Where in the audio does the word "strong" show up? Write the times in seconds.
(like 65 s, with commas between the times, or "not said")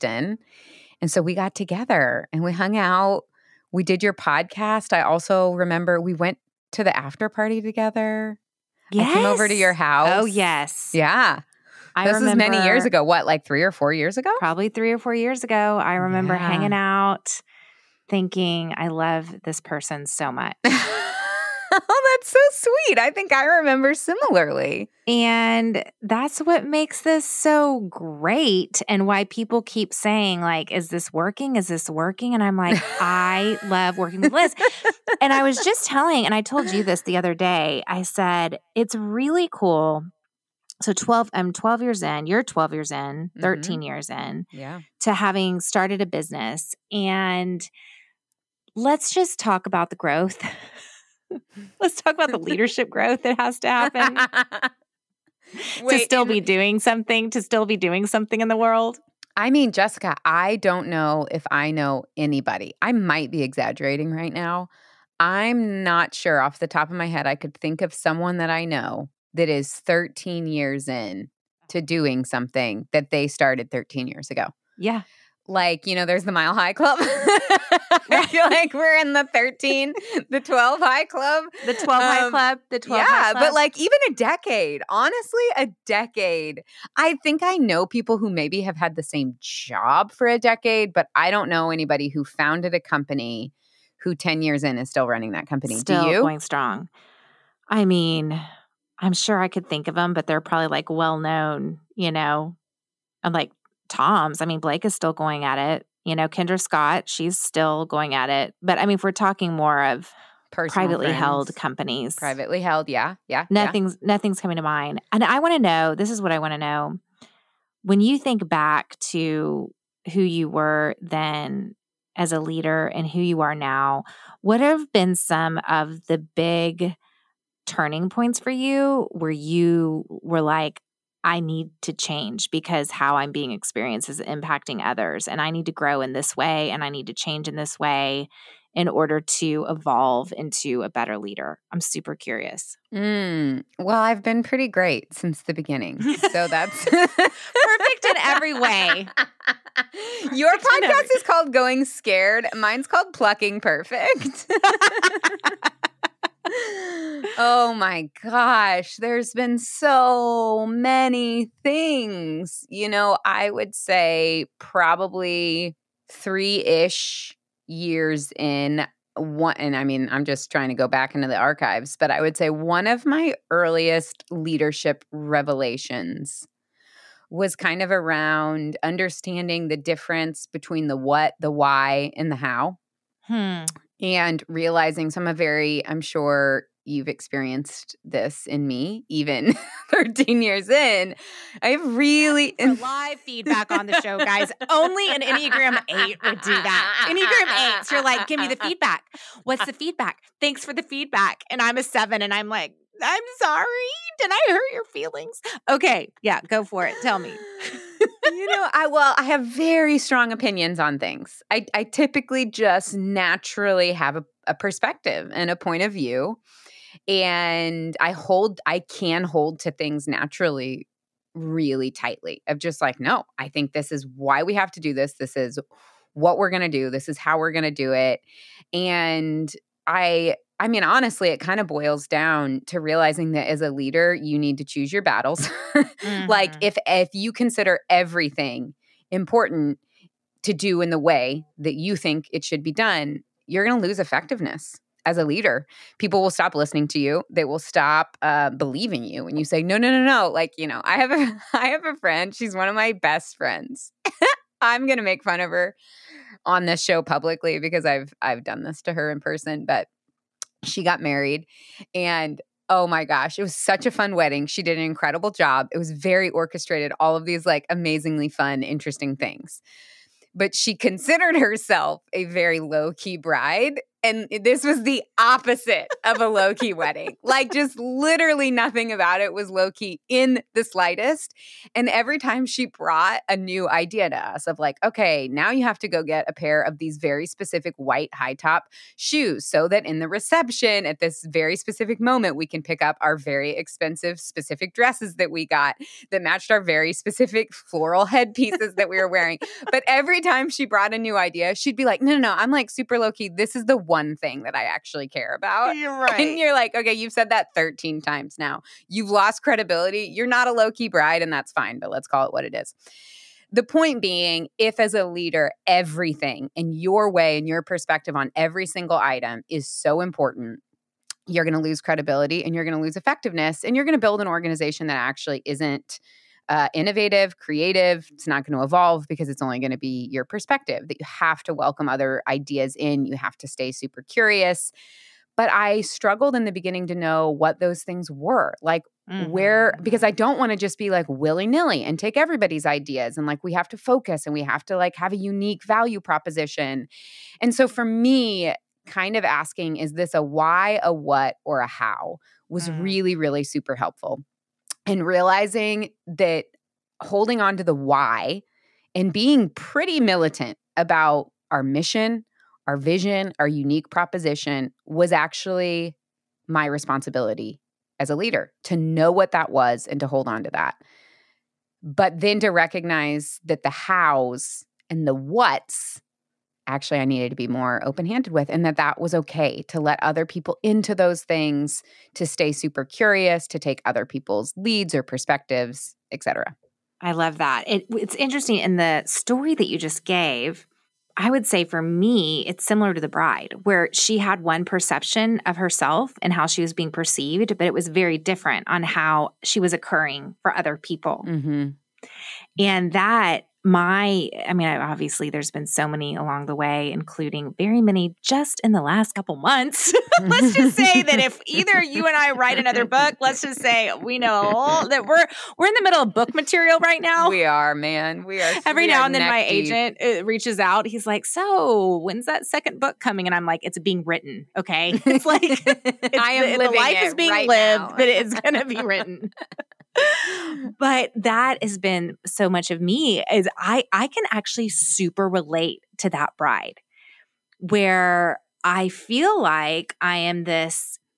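96 s, 209 s.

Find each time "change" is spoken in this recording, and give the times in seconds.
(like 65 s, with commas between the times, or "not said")
131 s, 137 s.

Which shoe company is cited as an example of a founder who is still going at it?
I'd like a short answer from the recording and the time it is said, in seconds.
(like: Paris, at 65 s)
Tom's, at 103 s.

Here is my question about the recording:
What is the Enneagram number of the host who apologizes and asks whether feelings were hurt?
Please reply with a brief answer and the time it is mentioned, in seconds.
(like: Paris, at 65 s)
7, at 201 s.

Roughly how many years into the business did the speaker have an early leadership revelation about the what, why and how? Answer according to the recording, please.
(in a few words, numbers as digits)
3.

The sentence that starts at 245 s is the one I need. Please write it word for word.
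People will stop listening to you.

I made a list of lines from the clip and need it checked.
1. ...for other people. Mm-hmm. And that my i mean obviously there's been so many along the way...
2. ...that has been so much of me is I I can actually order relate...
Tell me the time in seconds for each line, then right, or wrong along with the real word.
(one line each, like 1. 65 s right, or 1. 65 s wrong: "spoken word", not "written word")
1. 400 s right
2. 431 s wrong: "super", not "order".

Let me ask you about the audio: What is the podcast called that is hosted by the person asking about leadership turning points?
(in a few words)
Going Scared.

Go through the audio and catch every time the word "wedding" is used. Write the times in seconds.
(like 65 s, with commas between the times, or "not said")
264 s, 276 s.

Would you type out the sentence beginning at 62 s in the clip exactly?
I might be exaggerating right now.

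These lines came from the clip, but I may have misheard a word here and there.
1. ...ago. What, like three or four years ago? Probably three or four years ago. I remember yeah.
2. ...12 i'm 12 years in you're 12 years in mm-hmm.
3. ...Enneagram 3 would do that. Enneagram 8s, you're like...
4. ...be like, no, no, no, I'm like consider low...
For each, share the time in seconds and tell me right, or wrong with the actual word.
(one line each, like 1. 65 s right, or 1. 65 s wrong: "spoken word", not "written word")
1. 12 s right
2. 40 s right
3. 195 s wrong: "8", not "3"
4. 301 s wrong: "super", not "consider".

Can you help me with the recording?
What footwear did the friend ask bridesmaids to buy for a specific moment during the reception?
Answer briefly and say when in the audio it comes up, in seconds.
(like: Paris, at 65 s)
white high top shoes, at 287 s.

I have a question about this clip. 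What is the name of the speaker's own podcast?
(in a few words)
Plucking Perfect.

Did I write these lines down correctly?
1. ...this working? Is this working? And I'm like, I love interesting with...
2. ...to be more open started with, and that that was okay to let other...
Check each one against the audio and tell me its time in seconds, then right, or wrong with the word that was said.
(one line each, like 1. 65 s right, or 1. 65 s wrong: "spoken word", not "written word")
1. 30 s wrong: "working", not "interesting"
2. 377 s wrong: "handed", not "started".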